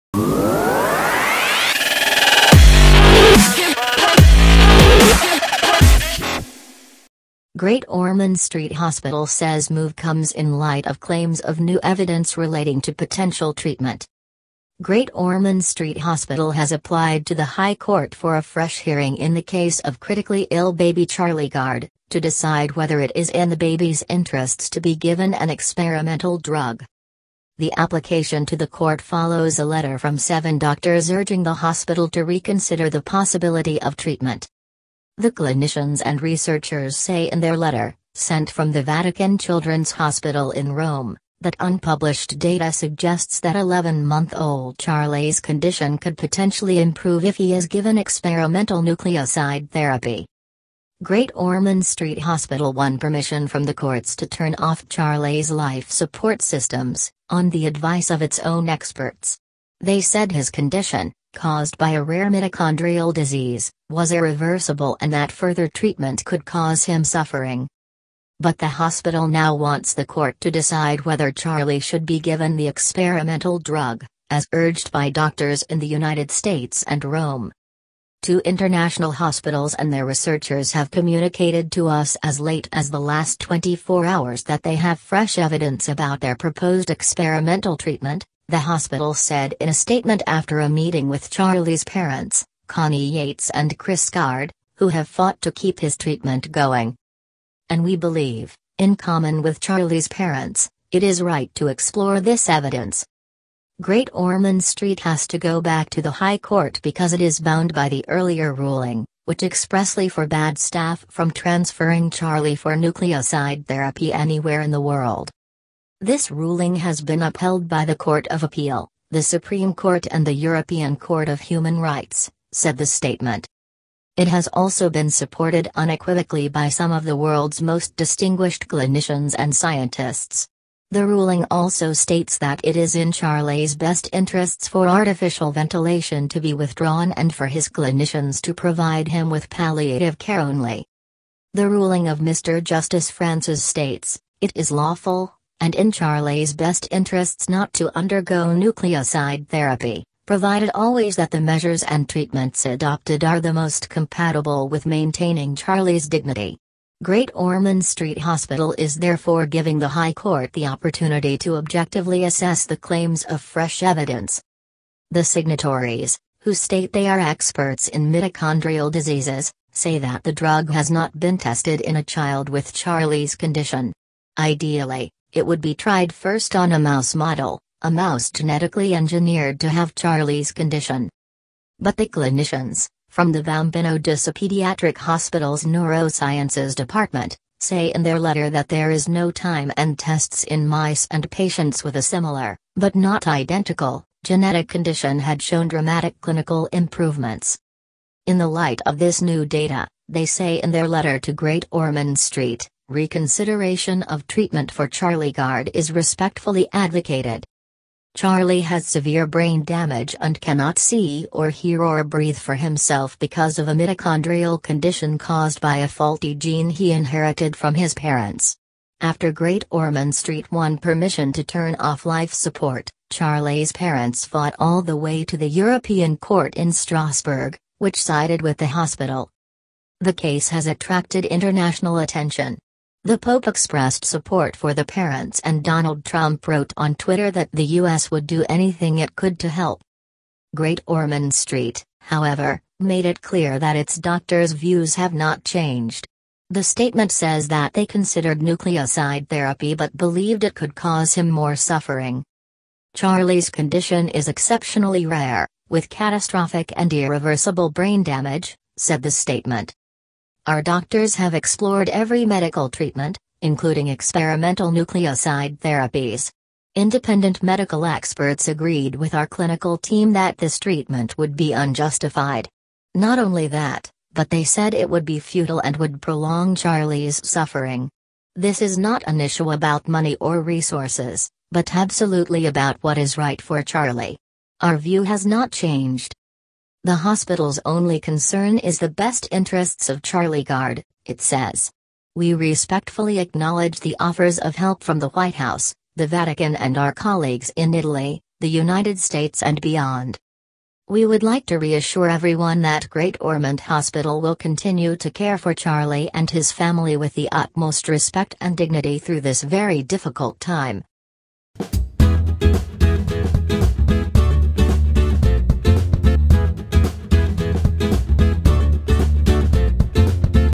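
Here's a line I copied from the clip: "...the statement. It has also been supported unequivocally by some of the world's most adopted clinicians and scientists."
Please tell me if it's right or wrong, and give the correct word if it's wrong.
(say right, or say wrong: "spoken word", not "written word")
wrong: "distinguished", not "adopted".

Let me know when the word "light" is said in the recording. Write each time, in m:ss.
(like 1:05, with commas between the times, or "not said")
0:10, 3:18.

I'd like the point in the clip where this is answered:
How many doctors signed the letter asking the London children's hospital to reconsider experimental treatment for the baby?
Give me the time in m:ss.
0:30.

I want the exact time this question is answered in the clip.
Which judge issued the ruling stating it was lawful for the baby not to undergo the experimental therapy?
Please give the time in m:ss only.
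2:22.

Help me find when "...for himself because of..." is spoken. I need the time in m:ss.
3:32.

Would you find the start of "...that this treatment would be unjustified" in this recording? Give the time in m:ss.
4:30.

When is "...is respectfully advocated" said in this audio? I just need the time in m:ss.
3:25.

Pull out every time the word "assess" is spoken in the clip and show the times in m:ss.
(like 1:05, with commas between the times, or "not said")
2:42.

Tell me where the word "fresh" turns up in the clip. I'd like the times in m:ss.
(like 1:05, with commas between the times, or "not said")
0:18, 1:24, 2:43.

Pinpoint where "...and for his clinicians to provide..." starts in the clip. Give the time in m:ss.
2:17.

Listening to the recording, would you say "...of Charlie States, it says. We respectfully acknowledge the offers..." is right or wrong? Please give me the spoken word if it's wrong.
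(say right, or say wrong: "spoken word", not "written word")
wrong: "Gard", not "States".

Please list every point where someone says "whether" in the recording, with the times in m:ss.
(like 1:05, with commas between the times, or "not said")
0:22, 1:11.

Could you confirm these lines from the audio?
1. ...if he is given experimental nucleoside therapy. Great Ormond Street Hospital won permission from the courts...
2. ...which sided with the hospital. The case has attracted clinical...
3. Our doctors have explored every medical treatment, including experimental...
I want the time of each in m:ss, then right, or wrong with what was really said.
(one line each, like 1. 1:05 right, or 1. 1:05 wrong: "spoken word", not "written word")
1. 0:47 right
2. 3:47 wrong: "international", not "clinical"
3. 4:20 right.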